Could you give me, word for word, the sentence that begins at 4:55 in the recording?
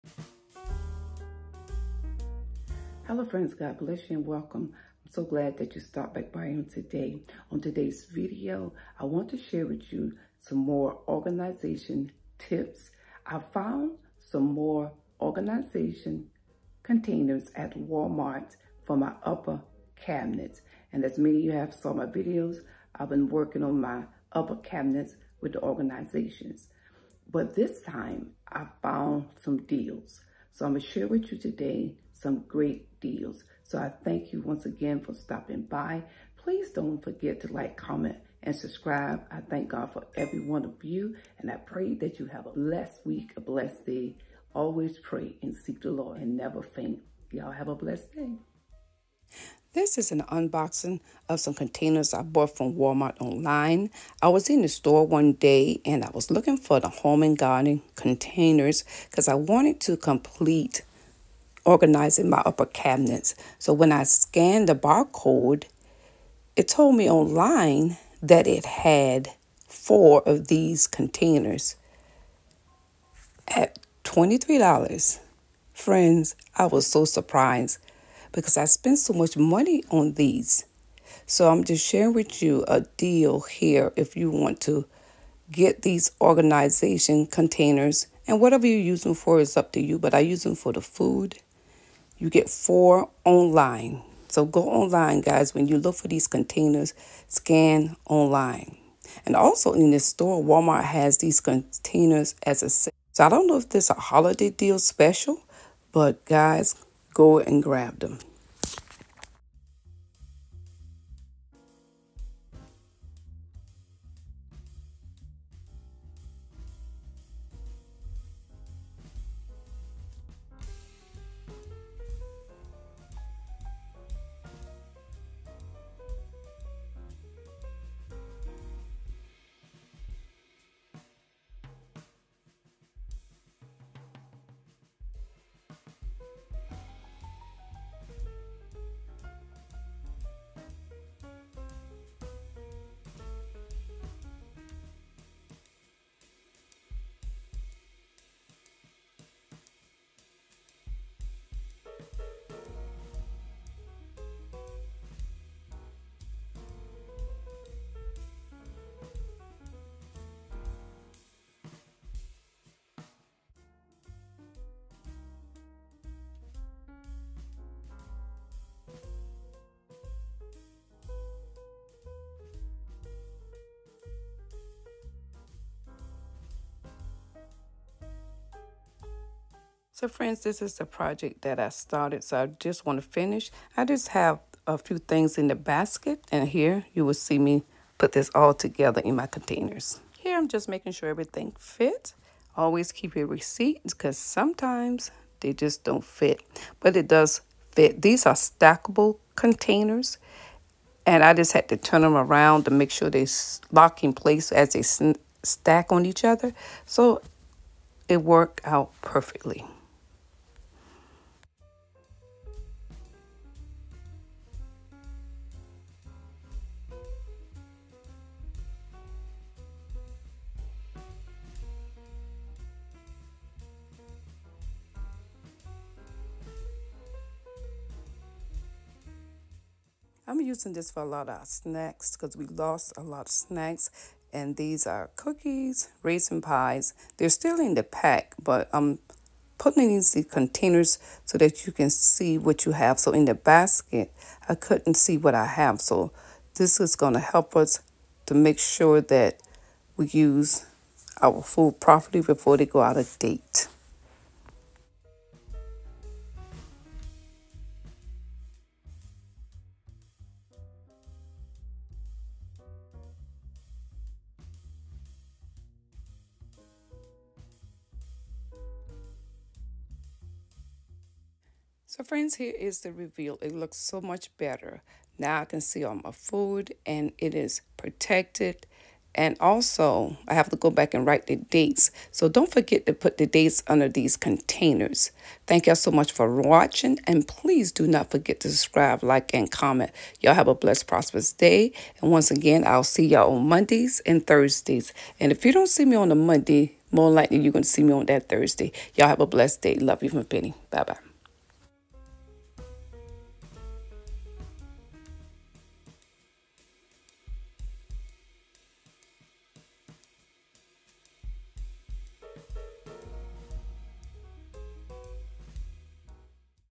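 And if you don't see me on a Monday, more likely you're going to see me on that Thursday.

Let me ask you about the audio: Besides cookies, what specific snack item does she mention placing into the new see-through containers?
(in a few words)
raisin pies.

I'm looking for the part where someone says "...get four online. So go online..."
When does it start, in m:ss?
1:32.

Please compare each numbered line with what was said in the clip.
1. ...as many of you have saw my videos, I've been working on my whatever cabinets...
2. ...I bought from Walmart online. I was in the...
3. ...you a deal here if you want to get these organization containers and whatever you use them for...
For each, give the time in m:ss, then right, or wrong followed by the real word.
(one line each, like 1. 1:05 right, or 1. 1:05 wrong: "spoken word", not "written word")
1. 0:21 wrong: "upper", not "whatever"
2. 0:52 right
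3. 1:22 right.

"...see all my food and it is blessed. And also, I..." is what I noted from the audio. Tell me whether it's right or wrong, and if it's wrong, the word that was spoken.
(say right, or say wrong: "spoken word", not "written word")
wrong: "protected", not "blessed".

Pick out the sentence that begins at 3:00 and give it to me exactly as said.
So friends, this is the project that I started.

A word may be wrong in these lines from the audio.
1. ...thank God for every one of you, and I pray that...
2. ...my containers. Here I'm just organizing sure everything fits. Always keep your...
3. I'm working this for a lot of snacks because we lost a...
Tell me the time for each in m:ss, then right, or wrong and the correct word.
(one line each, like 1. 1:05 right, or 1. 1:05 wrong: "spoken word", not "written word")
1. 0:39 right
2. 3:09 wrong: "making", not "organizing"
3. 3:50 wrong: "using", not "working".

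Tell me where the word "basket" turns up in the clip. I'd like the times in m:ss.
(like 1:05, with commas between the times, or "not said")
3:05, 4:03.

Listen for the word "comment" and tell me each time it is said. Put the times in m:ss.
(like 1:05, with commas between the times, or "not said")
0:37, 4:49.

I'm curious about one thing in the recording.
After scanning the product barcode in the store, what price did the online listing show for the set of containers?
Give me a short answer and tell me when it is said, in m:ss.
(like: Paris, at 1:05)
$23, at 1:14.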